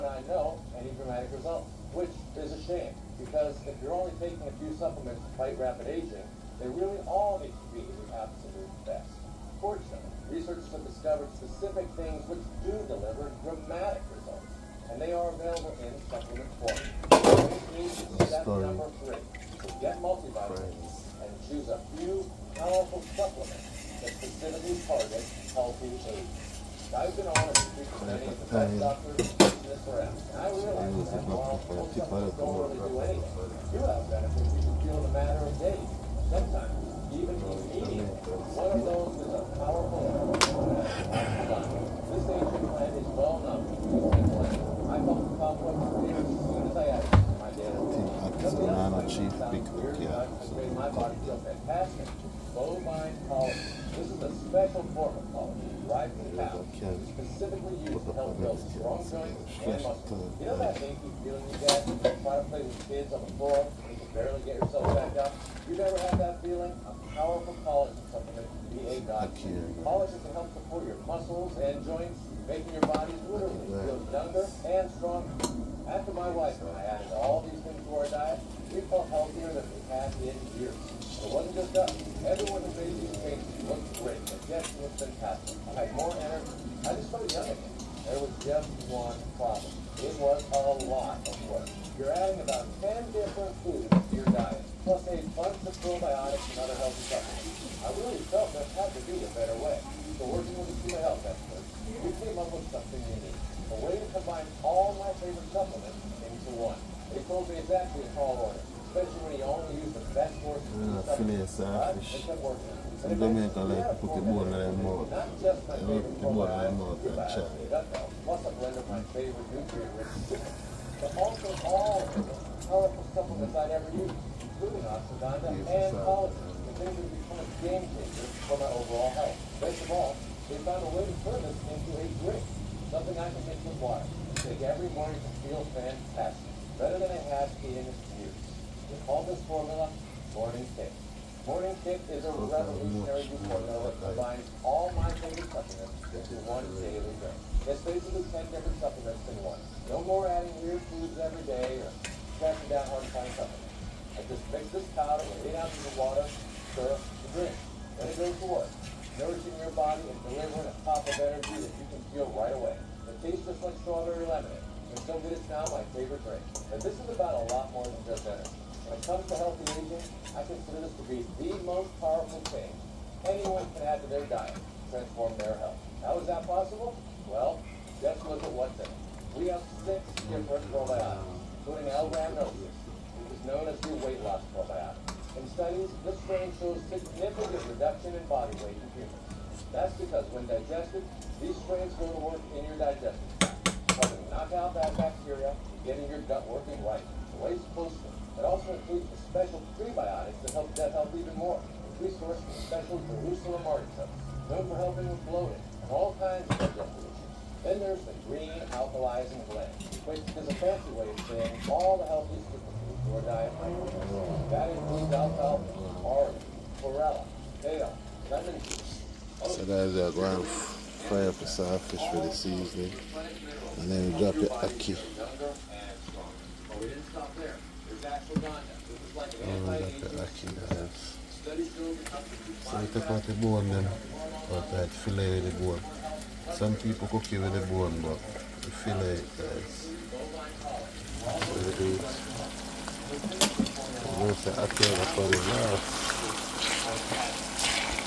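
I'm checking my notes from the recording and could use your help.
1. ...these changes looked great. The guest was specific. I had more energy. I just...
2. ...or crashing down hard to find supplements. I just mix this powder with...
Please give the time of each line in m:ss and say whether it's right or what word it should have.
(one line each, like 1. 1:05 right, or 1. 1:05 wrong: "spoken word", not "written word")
1. 1:23 wrong: "fantastic", not "specific"
2. 2:31 right.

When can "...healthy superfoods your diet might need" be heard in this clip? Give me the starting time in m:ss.
3:32.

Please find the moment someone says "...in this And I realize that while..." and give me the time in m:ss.
0:29.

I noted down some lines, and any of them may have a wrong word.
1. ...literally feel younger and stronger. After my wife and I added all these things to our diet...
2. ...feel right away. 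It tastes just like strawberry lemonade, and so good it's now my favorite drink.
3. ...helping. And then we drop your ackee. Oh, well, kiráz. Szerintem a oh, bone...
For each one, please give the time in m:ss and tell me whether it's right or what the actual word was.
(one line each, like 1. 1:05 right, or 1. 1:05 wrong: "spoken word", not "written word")
1. 1:13 right
2. 2:42 right
3. 3:42 wrong: "seasoning", not "helping".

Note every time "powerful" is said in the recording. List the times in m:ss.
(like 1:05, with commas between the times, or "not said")
0:22, 0:39, 1:07, 2:52.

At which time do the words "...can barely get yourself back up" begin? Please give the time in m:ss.
1:03.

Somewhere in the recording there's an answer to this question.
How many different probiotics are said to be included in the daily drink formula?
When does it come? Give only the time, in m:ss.
2:59.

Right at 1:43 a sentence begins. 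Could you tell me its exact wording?
A way to combine all my favorite supplements into one.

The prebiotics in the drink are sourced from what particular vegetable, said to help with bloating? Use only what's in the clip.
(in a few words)
Jerusalem artichokes.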